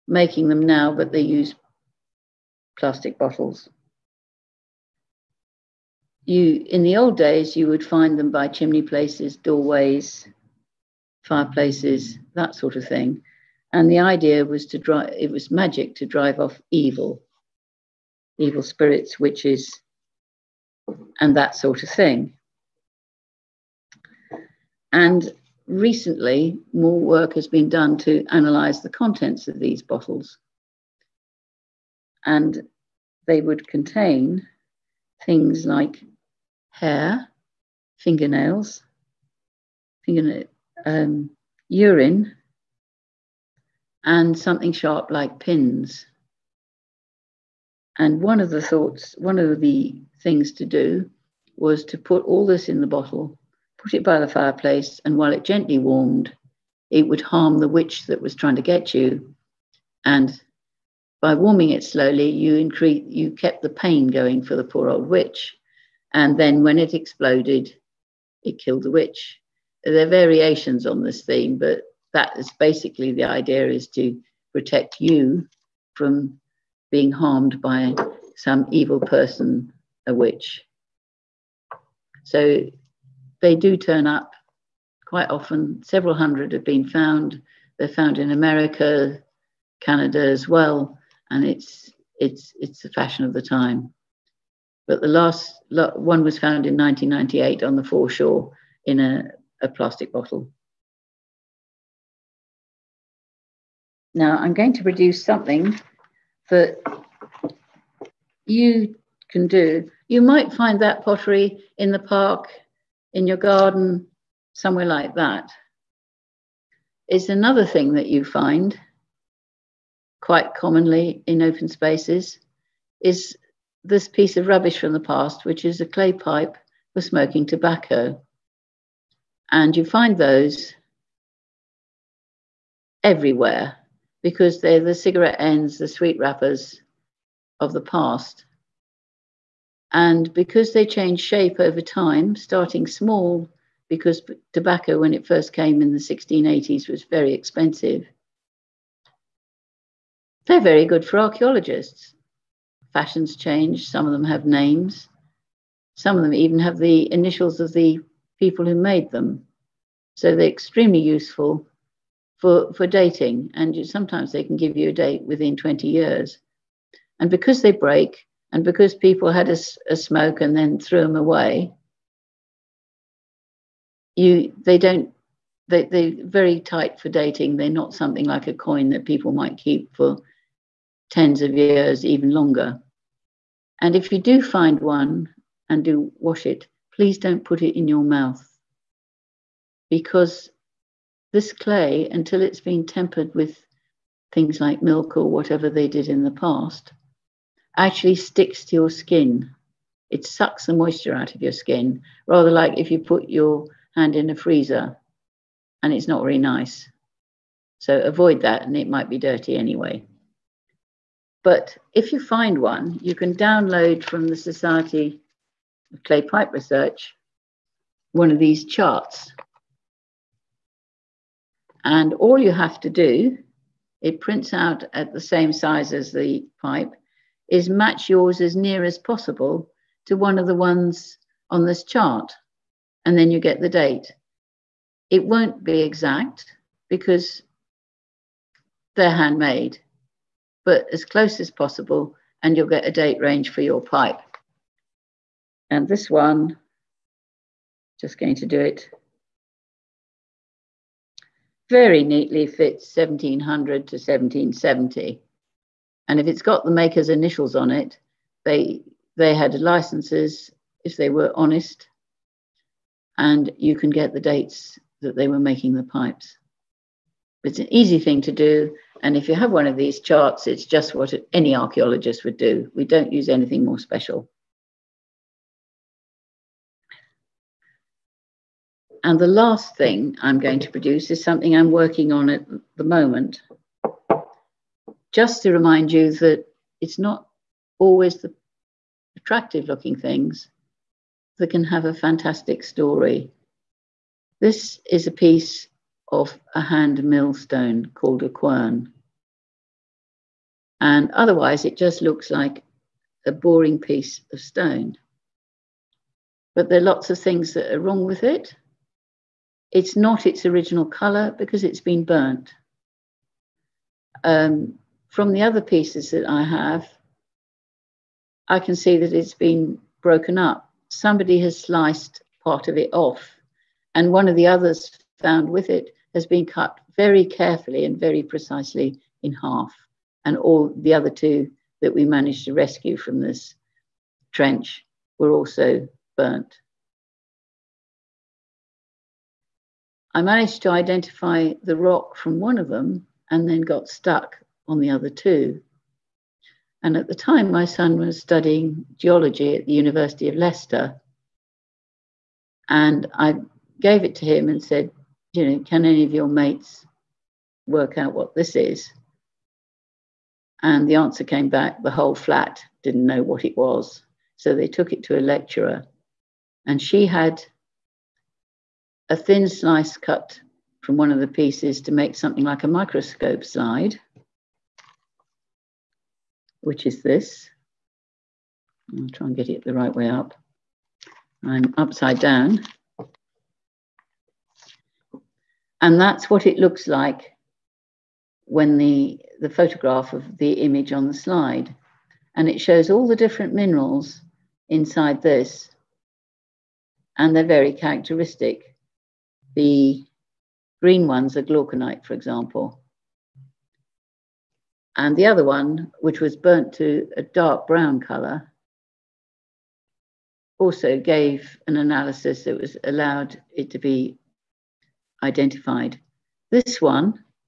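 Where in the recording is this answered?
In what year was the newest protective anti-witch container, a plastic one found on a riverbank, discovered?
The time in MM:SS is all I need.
01:36.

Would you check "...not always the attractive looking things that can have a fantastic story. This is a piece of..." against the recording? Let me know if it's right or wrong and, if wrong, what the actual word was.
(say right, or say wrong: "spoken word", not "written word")
right.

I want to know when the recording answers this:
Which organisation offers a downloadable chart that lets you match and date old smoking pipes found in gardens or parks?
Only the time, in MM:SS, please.
03:34.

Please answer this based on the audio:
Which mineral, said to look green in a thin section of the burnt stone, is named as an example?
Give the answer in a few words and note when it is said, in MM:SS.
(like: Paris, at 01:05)
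glauconite, at 06:41.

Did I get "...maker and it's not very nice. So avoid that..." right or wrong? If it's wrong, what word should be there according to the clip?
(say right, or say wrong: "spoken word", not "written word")
wrong: "freezer", not "maker".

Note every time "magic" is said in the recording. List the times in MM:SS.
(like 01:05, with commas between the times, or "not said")
00:15.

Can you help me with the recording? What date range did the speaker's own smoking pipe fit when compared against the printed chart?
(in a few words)
1700 to 1770.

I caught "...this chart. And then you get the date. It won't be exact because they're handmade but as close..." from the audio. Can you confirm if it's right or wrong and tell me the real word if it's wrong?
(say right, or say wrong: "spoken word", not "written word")
right.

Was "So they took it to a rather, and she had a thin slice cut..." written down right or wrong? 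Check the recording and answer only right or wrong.
wrong.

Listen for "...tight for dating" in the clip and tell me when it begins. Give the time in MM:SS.
02:56.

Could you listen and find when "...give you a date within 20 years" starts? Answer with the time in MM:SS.
02:44.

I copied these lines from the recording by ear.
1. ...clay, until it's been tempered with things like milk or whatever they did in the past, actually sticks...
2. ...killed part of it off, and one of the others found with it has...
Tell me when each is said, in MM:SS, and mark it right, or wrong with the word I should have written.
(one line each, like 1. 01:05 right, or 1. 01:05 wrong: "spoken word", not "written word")
1. 03:11 right
2. 05:21 wrong: "sliced", not "killed".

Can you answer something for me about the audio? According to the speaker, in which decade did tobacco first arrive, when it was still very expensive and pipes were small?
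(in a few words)
1680s.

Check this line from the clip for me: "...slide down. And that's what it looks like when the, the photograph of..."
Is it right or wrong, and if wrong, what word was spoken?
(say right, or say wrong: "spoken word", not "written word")
wrong: "upside", not "slide".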